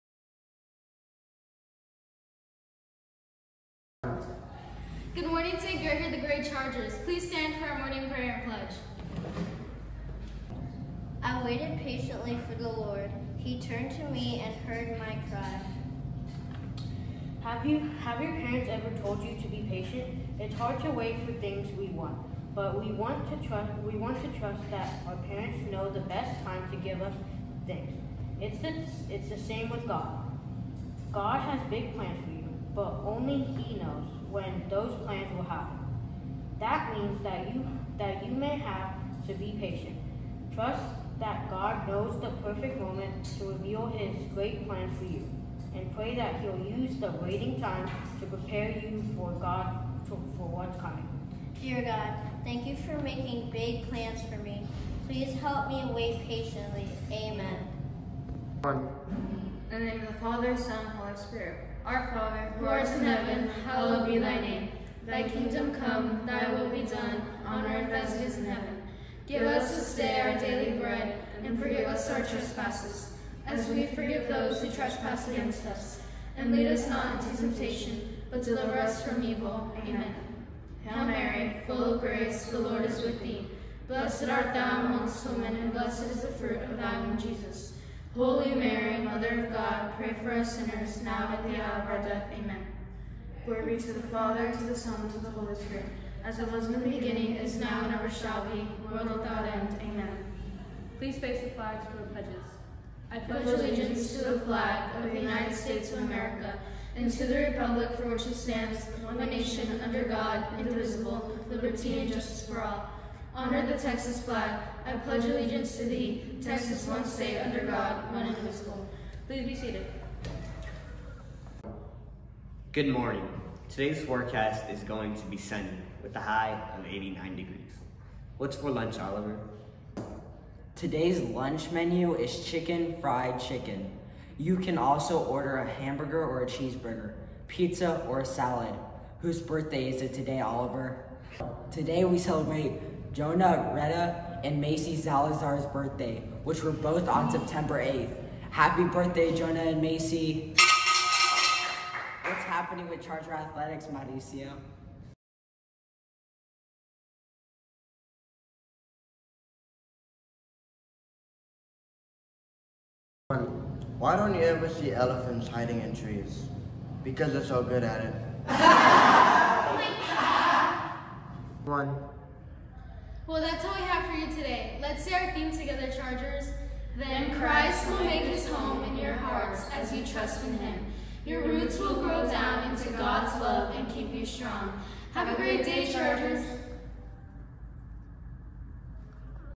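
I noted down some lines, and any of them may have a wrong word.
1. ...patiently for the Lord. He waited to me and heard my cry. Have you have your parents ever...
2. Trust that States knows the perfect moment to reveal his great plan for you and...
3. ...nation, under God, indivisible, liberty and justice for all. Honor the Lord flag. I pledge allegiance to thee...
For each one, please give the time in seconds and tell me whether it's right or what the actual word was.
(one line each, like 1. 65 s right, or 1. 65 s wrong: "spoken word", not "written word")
1. 11 s wrong: "turned", not "waited"
2. 40 s wrong: "God", not "States"
3. 109 s wrong: "Texas", not "Lord".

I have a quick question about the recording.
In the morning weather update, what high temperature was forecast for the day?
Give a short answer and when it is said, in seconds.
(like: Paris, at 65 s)
89 degrees, at 126 s.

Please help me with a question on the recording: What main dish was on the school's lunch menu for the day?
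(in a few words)
chicken fried chicken.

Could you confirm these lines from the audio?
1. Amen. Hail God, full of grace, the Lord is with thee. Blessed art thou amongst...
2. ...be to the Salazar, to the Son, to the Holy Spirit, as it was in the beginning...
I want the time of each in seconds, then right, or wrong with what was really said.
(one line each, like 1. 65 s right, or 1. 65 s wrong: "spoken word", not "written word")
1. 79 s wrong: "Mary", not "God"
2. 93 s wrong: "Father", not "Salazar".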